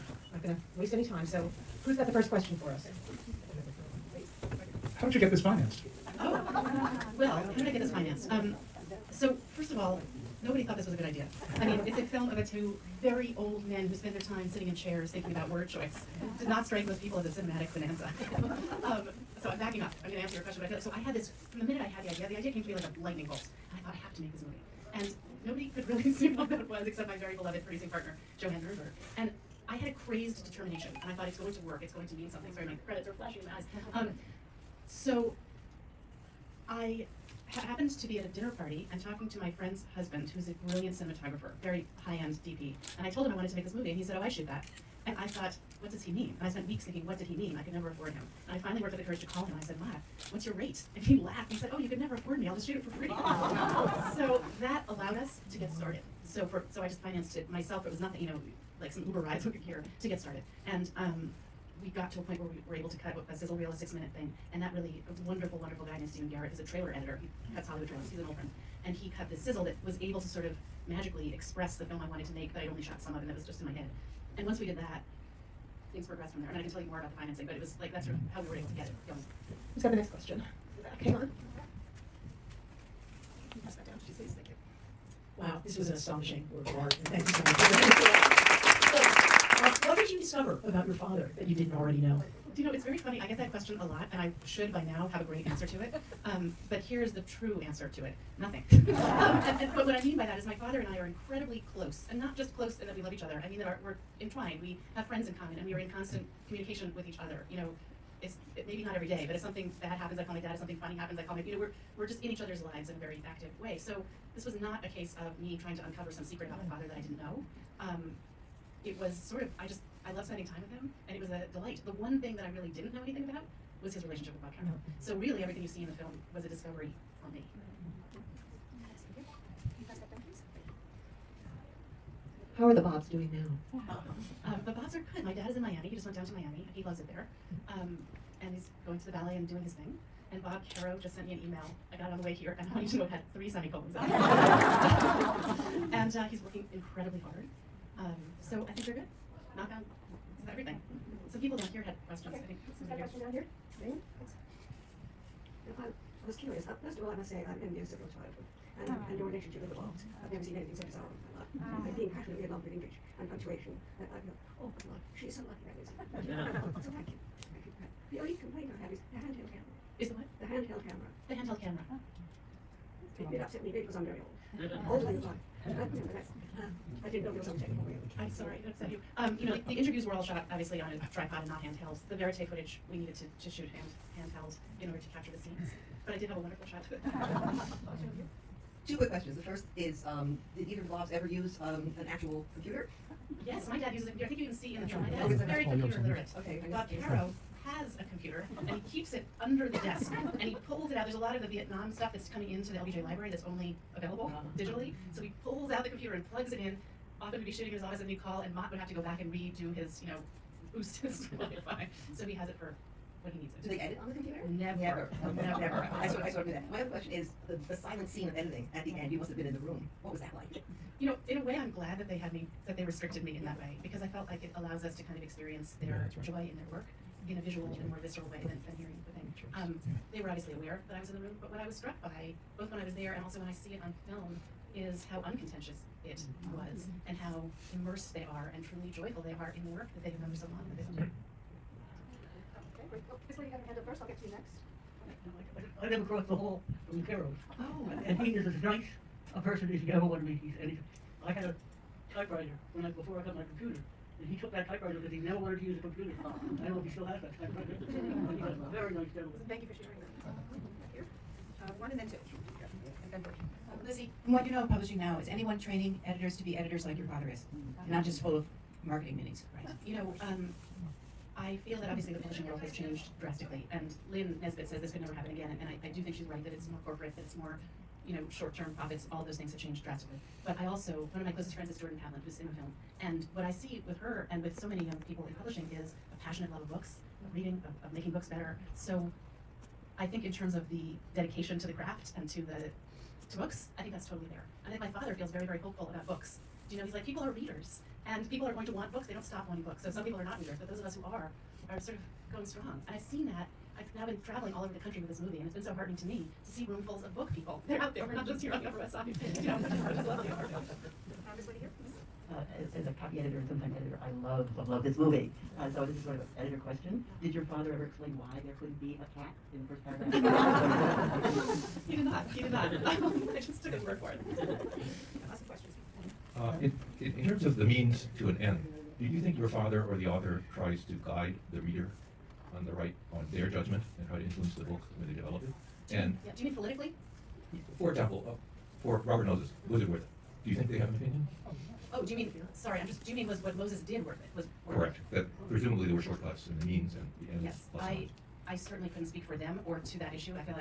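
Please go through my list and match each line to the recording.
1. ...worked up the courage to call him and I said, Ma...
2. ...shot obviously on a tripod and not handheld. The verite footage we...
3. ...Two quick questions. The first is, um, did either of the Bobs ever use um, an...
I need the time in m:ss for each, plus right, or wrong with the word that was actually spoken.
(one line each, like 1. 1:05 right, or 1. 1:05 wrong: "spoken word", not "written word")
1. 0:48 right
2. 3:00 right
3. 3:08 right.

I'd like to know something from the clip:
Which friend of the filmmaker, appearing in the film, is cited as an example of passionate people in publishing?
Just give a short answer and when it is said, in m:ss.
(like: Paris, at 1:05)
Jordan Pavlin, at 4:41.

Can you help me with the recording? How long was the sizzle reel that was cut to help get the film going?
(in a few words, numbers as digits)
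6 minutes.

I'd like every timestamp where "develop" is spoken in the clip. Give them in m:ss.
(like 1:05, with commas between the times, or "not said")
5:35.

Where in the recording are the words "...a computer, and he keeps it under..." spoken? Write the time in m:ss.
3:17.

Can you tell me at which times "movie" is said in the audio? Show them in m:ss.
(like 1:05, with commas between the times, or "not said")
0:24, 0:43, 5:05, 5:14.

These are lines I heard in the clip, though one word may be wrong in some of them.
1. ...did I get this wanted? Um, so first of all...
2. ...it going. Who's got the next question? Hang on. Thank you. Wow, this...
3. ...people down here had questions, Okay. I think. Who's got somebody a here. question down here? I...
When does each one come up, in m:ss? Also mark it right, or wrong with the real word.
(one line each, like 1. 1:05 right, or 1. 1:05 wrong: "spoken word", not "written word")
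1. 0:07 wrong: "financed", not "wanted"
2. 1:18 right
3. 2:31 right.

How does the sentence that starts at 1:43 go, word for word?
I mean that our, we're entwined.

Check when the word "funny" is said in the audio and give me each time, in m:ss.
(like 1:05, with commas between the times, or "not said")
1:32, 1:50.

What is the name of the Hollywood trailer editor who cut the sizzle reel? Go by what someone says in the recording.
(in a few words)
Stephen Garrett.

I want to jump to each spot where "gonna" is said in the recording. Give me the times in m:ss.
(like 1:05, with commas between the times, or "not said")
0:00.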